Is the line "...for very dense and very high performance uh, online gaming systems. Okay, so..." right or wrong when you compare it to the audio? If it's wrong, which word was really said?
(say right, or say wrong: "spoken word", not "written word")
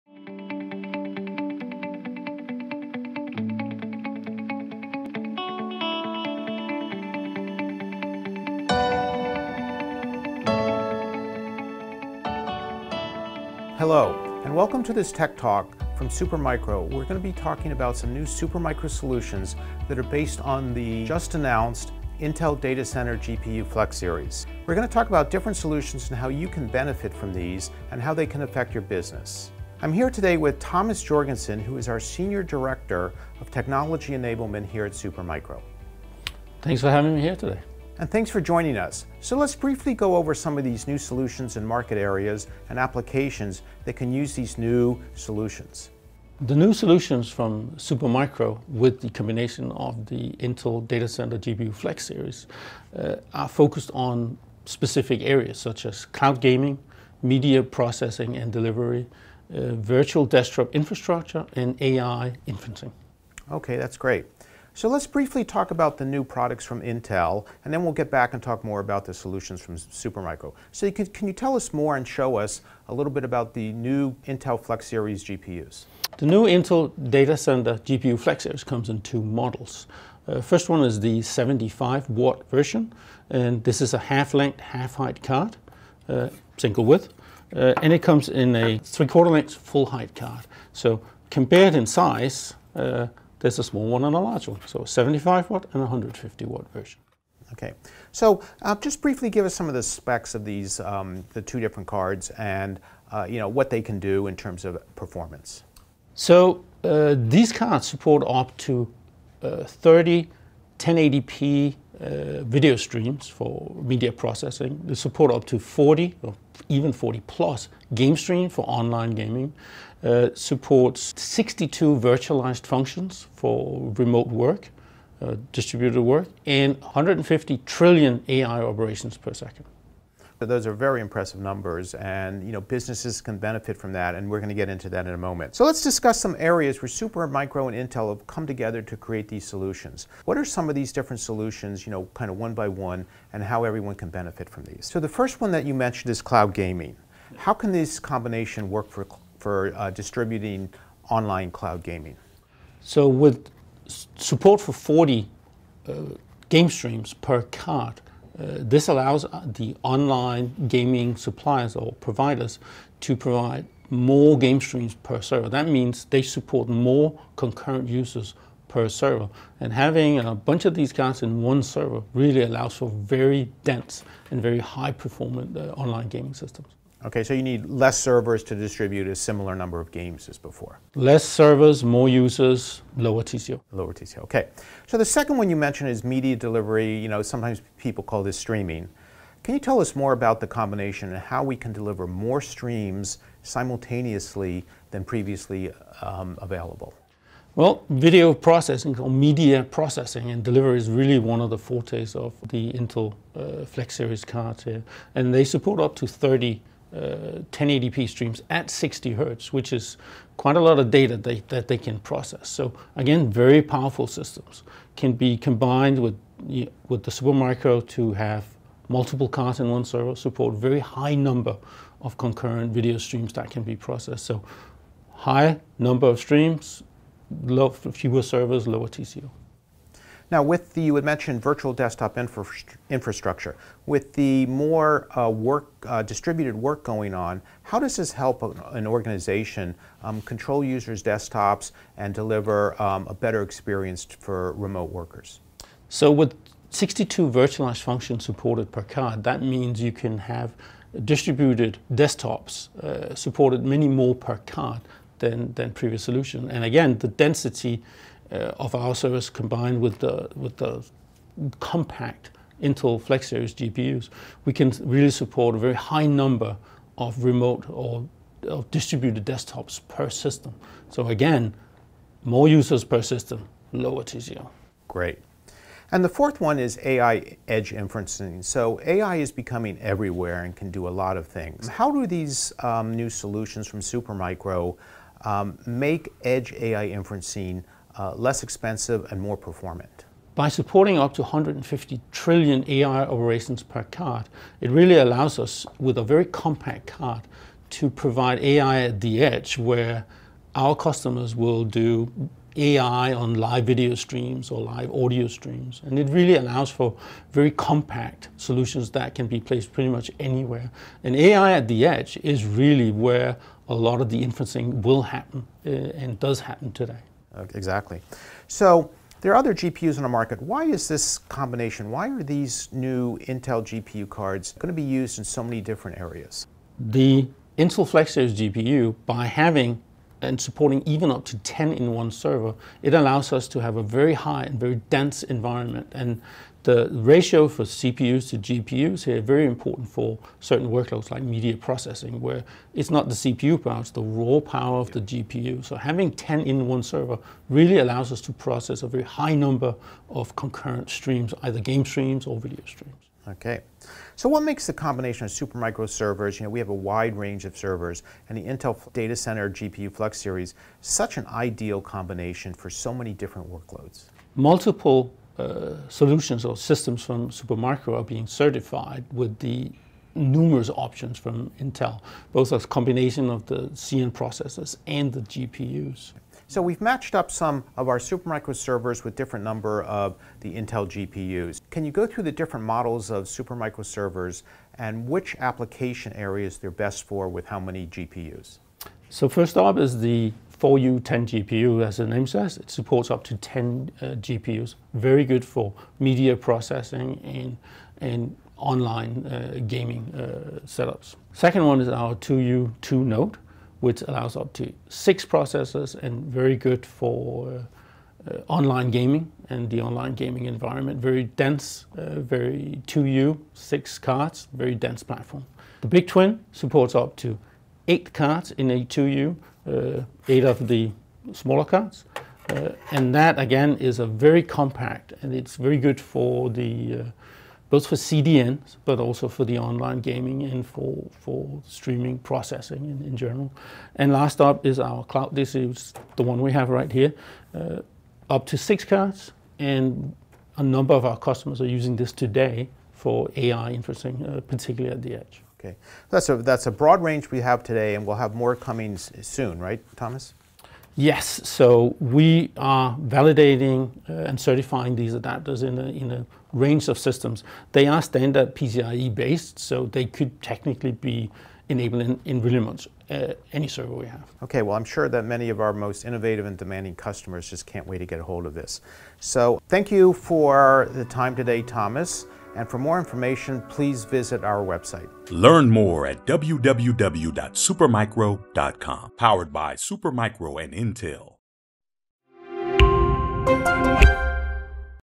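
right.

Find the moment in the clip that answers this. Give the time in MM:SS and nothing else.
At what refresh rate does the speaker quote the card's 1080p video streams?
03:28.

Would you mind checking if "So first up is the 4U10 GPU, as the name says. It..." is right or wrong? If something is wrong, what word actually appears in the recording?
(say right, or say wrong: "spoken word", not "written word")
right.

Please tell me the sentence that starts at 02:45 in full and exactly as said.
That means they support more concurrent users per server.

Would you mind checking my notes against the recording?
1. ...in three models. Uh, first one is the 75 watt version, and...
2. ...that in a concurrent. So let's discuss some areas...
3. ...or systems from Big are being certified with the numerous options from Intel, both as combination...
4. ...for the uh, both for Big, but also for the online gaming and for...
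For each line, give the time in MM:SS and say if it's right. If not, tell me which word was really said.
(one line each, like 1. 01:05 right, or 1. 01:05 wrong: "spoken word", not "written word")
1. 01:18 wrong: "two", not "three"
2. 02:14 wrong: "moment", not "concurrent"
3. 06:06 wrong: "Supermicro", not "Big"
4. 07:05 wrong: "CDNs", not "Big".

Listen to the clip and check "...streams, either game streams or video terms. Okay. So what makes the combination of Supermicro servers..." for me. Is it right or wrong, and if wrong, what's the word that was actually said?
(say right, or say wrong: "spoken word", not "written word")
wrong: "streams", not "terms".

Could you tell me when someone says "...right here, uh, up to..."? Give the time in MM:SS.
07:16.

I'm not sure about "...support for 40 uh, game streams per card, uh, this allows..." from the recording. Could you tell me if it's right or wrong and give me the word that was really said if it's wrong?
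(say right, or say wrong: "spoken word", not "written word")
right.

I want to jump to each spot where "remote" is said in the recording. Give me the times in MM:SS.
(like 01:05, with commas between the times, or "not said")
02:03, 04:04, 04:27.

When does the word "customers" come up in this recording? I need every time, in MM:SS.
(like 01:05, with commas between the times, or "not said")
05:00, 07:21, 07:46.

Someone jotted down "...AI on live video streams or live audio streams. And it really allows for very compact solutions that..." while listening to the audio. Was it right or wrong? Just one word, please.
right.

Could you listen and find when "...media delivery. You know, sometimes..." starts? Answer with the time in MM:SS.
03:06.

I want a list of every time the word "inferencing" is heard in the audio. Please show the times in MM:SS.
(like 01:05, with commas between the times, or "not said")
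01:02, 04:37, 04:46, 05:14, 07:23.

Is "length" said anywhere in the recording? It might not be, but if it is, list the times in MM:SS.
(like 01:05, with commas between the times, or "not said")
01:24, 01:29.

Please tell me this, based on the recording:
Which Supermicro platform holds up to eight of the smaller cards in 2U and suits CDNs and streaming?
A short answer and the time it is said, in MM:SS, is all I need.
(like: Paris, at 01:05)
Big Twin, at 06:55.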